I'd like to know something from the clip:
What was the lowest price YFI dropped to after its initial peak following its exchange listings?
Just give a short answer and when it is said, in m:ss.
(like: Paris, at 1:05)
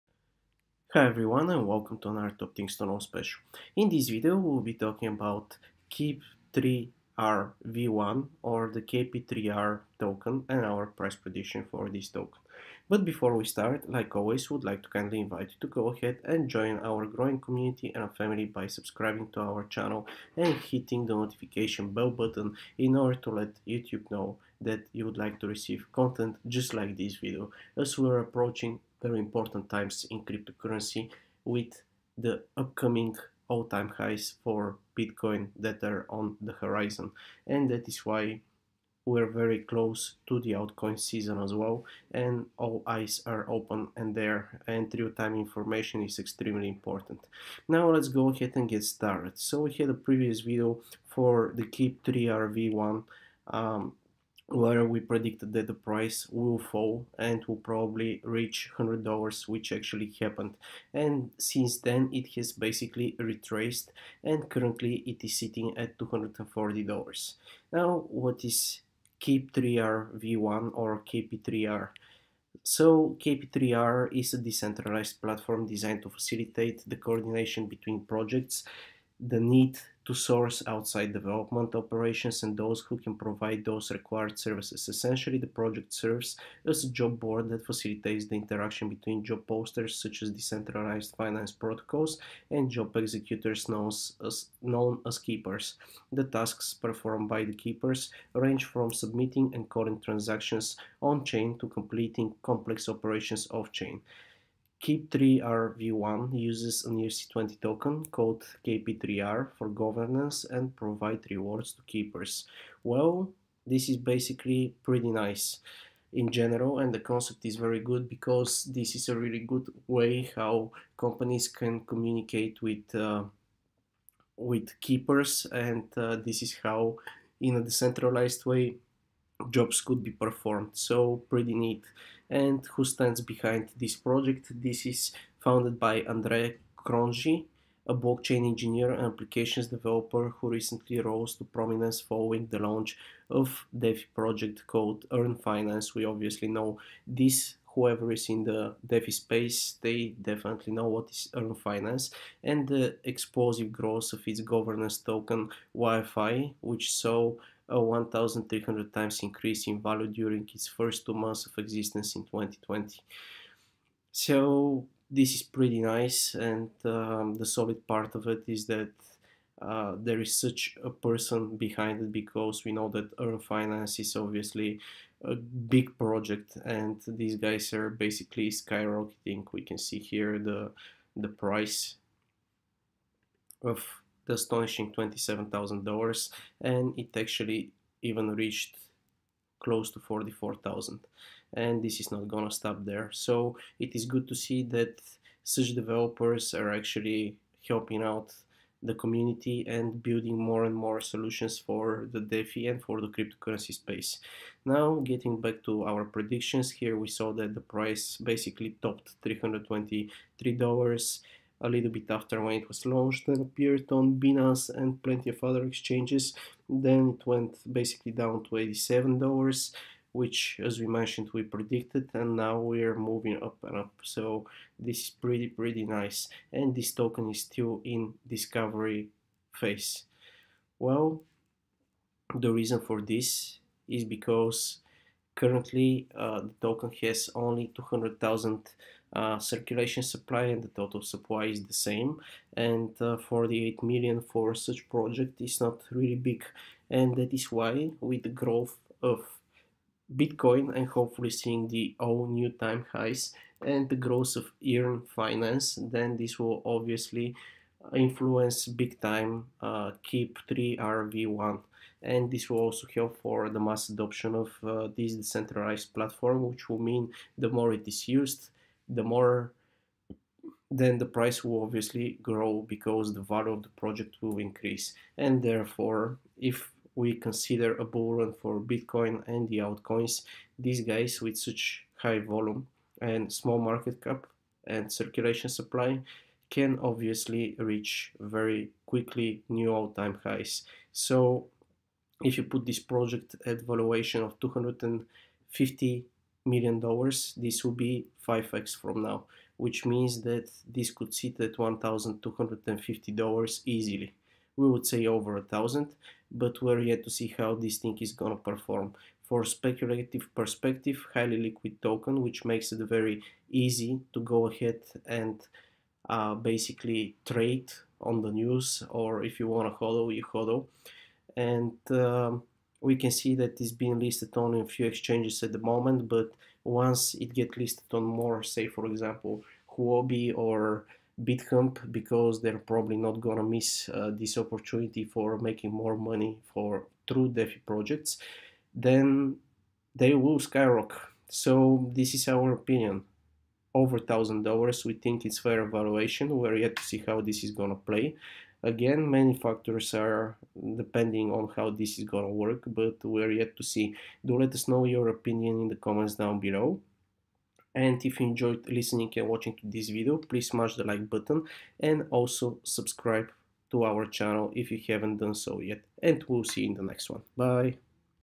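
$87, at 3:38.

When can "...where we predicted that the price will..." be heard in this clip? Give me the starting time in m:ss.
0:54.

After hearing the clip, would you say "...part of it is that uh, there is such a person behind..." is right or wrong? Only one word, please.
right.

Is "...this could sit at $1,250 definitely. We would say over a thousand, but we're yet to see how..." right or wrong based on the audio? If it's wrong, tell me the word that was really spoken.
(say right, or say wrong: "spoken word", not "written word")
wrong: "easily", not "definitely".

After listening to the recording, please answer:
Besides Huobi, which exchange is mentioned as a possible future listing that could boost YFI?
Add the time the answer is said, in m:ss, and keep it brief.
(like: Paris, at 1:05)
Bitcamp, at 5:31.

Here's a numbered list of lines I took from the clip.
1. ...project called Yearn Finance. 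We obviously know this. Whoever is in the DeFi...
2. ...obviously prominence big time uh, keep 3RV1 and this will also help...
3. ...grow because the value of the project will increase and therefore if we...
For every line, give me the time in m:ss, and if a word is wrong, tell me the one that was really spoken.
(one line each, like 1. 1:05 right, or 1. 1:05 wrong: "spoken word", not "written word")
1. 2:24 right
2. 4:16 wrong: "influence", not "prominence"
3. 4:32 right.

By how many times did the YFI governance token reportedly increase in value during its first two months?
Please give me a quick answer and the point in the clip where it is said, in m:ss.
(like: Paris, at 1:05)
1,300, at 2:37.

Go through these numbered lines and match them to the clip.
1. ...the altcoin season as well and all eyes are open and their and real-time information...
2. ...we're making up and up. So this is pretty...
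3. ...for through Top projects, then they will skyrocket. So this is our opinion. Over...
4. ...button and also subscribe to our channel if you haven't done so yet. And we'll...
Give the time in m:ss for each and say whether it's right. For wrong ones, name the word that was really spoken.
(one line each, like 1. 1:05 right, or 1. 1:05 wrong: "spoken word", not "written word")
1. 0:40 right
2. 3:42 wrong: "moving", not "making"
3. 5:36 wrong: "DeFi", not "Top"
4. 6:01 right.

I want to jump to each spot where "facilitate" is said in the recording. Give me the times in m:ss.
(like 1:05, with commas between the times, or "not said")
1:16, 1:27.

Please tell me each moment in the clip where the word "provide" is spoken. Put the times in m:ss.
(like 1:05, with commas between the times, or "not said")
1:23, 1:50.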